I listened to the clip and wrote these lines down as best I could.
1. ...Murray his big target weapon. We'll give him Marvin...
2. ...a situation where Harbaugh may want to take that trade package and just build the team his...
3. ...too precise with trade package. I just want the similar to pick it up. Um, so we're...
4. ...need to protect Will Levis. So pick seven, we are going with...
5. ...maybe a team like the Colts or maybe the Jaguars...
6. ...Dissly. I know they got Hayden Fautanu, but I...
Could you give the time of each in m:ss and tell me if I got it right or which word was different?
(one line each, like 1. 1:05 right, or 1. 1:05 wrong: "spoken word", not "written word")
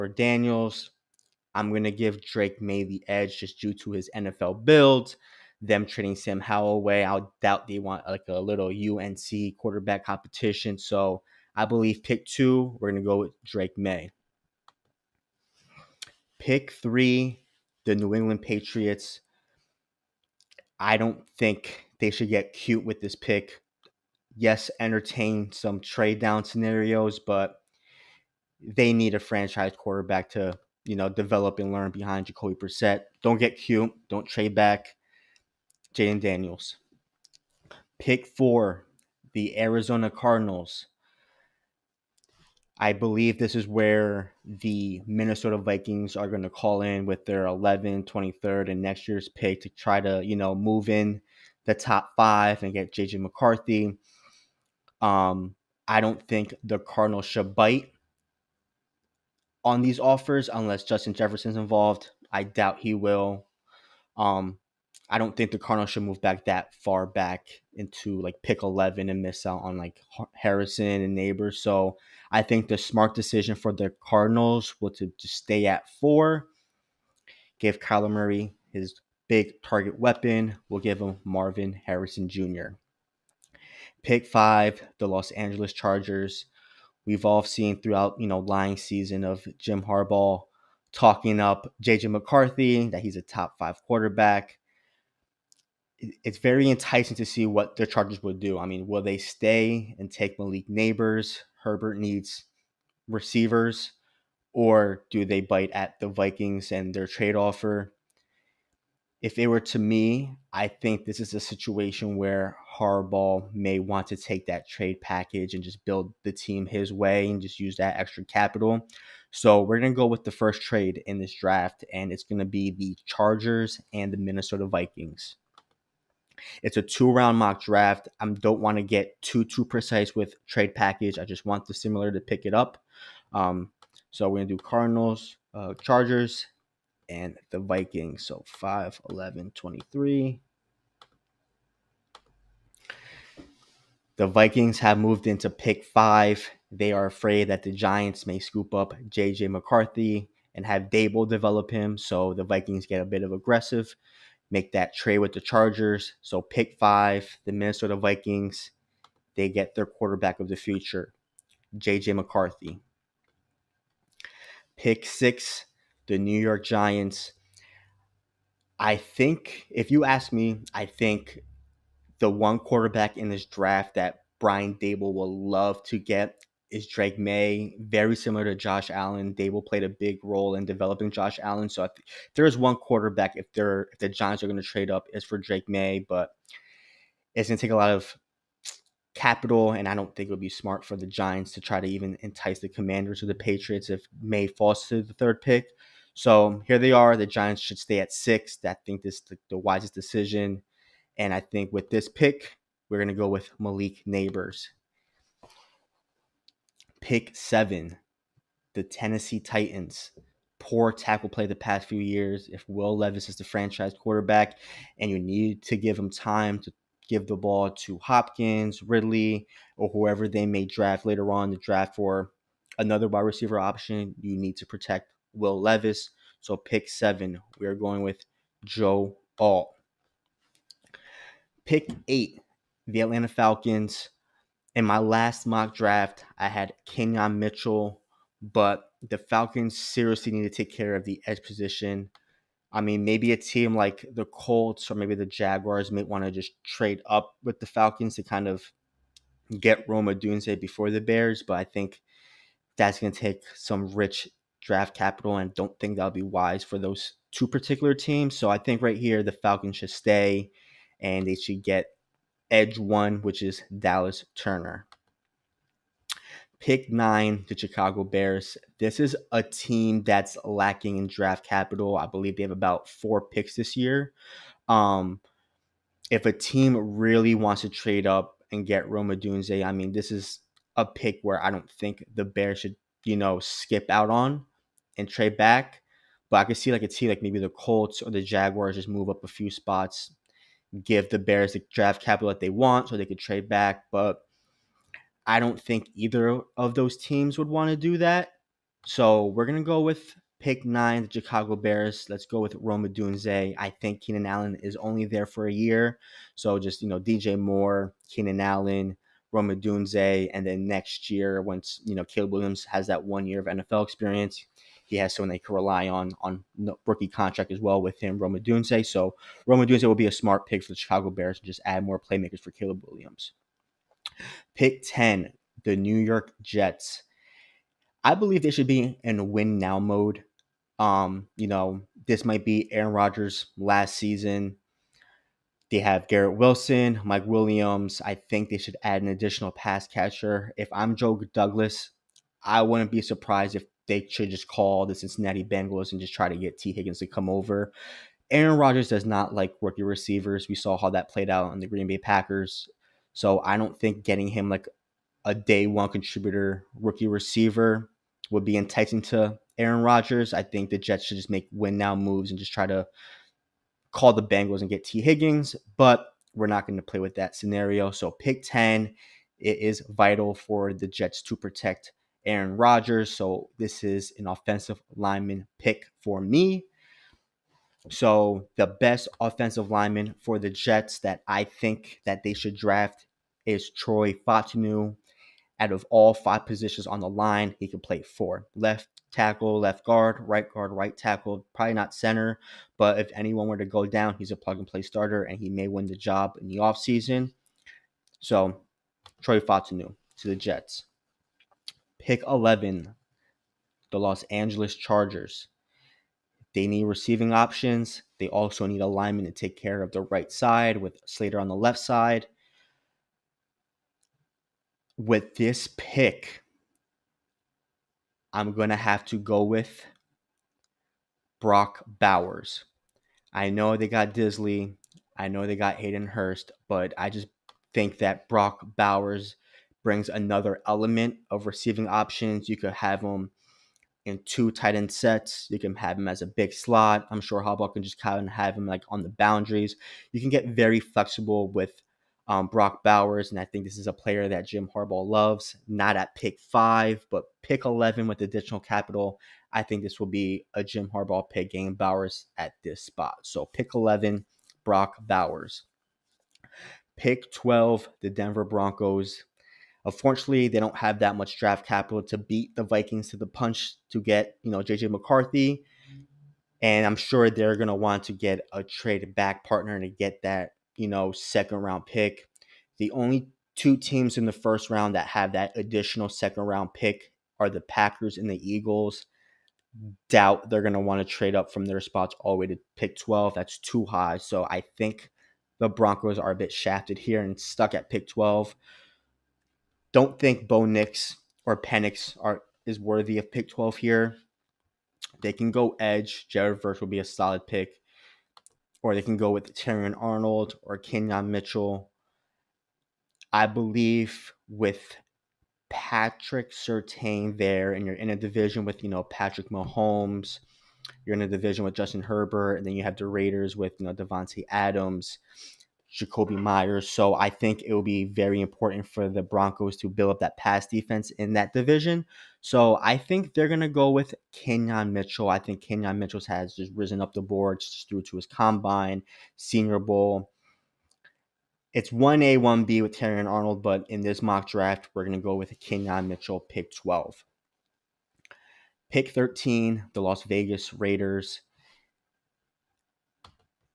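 1. 1:18 right
2. 1:51 right
3. 2:09 right
4. 3:44 right
5. 4:03 right
6. 7:04 wrong: "Hurst", not "Fautanu".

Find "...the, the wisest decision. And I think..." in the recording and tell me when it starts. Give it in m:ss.
3:19.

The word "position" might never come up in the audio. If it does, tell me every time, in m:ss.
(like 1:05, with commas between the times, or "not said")
4:01, 6:26.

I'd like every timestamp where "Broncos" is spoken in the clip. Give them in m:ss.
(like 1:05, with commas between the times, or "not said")
7:38, 8:05, 8:39.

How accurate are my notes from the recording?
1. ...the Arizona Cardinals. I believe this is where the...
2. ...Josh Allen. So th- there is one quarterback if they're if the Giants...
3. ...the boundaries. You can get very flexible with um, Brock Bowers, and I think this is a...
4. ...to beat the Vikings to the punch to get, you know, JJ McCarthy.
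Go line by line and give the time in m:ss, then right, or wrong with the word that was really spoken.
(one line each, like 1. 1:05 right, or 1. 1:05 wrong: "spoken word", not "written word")
1. 0:39 right
2. 3:01 right
3. 7:19 right
4. 7:42 right.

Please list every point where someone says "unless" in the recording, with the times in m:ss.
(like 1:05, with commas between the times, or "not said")
1:00.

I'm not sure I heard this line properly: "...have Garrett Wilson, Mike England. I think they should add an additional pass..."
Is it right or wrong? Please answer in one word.
wrong.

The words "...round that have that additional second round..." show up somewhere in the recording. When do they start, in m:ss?
7:54.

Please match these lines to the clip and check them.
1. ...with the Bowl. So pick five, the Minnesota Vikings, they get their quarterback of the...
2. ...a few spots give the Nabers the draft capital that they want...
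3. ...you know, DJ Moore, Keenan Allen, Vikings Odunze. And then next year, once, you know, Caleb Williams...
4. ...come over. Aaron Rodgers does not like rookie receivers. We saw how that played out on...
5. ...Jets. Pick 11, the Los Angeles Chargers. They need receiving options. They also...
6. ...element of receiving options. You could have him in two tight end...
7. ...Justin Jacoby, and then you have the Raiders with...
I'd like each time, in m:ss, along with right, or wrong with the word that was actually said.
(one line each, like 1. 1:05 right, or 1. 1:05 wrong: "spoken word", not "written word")
1. 2:35 wrong: "Chargers", not "Bowl"
2. 4:49 wrong: "Bears", not "Nabers"
3. 5:06 wrong: "Rome", not "Vikings"
4. 5:47 right
5. 6:40 right
6. 7:10 right
7. 8:31 wrong: "Herbert", not "Jacoby".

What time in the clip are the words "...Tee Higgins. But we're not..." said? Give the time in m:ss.
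6:04.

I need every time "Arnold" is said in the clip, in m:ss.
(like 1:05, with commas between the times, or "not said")
8:19, 8:53.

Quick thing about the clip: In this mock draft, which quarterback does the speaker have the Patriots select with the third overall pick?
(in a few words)
Jayden Daniels.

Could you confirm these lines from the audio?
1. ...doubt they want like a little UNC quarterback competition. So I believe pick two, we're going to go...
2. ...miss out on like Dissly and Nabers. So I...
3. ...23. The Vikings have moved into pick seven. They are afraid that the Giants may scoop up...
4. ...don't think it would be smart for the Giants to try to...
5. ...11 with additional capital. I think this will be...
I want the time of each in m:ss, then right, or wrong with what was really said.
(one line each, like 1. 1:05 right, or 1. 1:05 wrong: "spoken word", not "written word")
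1. 0:07 right
2. 1:09 wrong: "Harrison", not "Dissly"
3. 2:19 wrong: "five", not "seven"
4. 3:09 right
5. 7:27 right.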